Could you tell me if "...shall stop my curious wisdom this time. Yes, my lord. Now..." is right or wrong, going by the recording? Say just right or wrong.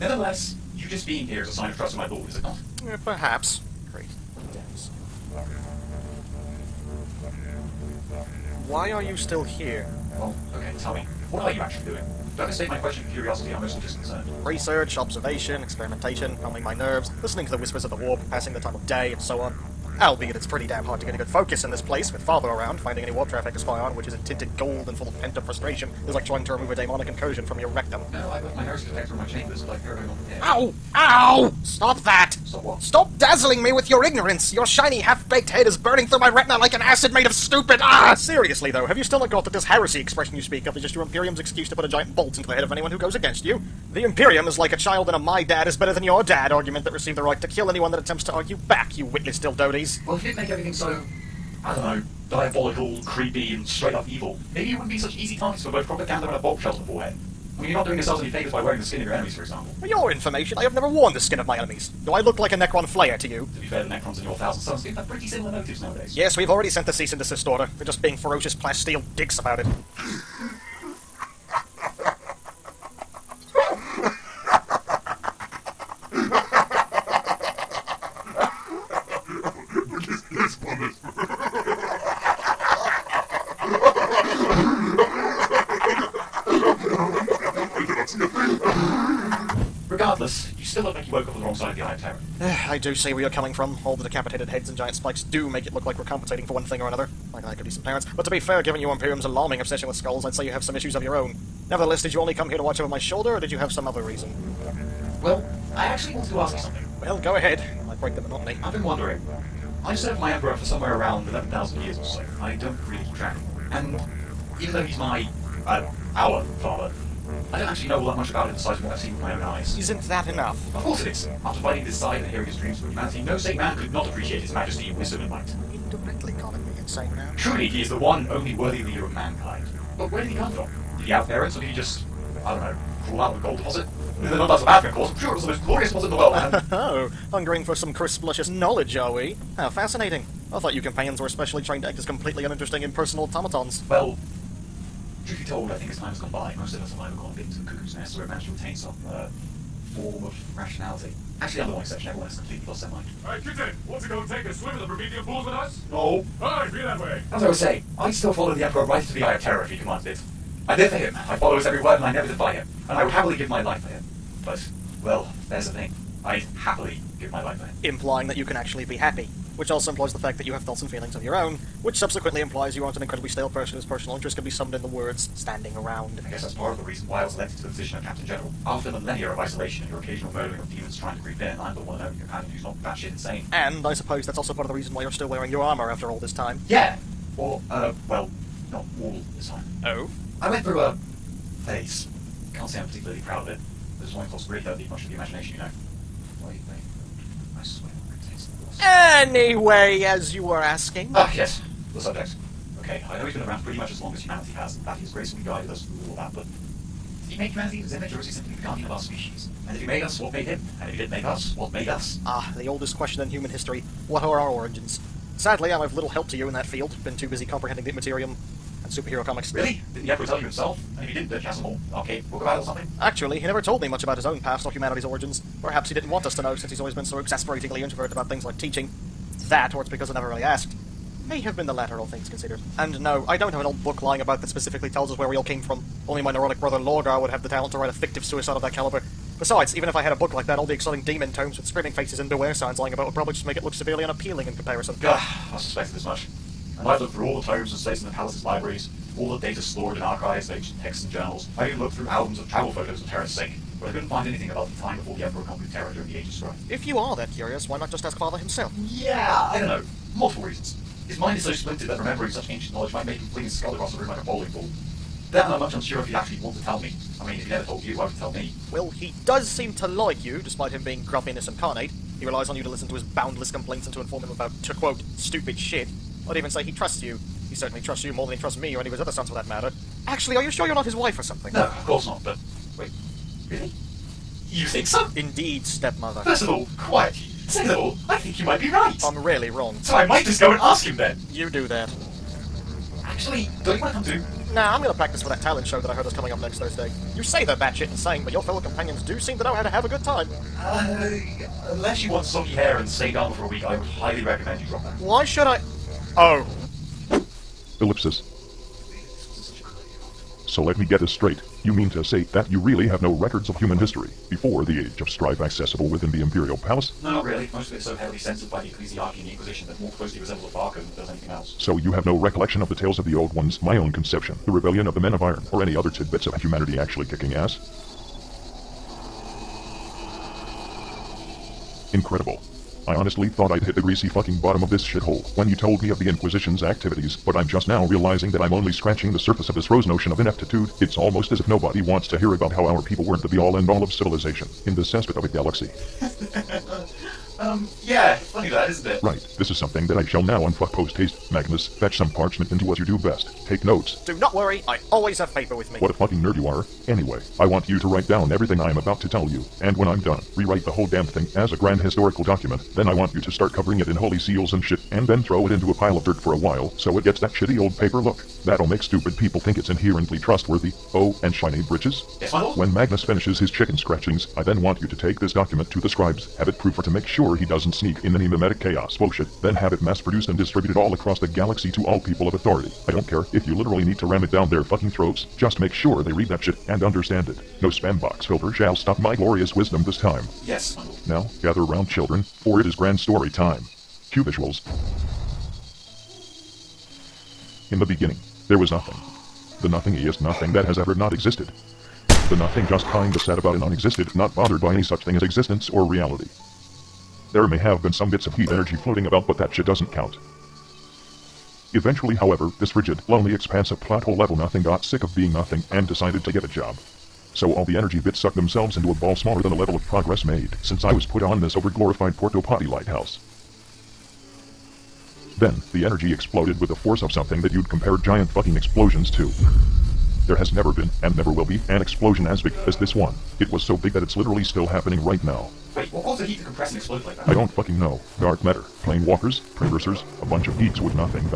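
wrong.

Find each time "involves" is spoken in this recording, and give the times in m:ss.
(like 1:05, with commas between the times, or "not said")
not said.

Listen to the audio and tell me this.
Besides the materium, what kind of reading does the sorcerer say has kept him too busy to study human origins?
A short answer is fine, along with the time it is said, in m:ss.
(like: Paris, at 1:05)
superhero comics, at 3:38.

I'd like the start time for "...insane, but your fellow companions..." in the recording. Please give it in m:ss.
4:57.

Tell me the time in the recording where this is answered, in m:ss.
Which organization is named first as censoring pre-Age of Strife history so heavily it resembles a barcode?
5:18.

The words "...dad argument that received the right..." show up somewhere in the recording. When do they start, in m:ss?
0:46.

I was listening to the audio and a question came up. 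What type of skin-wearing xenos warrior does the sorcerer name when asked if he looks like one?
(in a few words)
Necron Flayer.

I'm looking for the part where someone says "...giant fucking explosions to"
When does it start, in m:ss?
7:07.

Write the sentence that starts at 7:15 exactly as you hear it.
Wait, what caused the heat to compress and explode like that?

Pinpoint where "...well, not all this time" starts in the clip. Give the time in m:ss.
3:08.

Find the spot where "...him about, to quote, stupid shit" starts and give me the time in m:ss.
4:34.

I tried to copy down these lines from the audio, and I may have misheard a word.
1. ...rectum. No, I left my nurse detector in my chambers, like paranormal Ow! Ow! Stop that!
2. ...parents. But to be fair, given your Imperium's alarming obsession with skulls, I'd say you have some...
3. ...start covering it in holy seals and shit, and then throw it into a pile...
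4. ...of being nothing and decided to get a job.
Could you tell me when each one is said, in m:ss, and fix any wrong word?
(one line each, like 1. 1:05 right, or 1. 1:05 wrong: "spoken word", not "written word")
1. 0:27 right
2. 1:37 right
3. 6:03 right
4. 6:55 right.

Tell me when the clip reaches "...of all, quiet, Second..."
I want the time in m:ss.
4:46.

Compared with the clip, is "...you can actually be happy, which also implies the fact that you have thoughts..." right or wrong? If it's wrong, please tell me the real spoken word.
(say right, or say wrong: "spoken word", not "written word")
right.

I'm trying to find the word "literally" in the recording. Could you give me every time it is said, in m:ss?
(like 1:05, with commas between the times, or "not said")
6:23, 7:14.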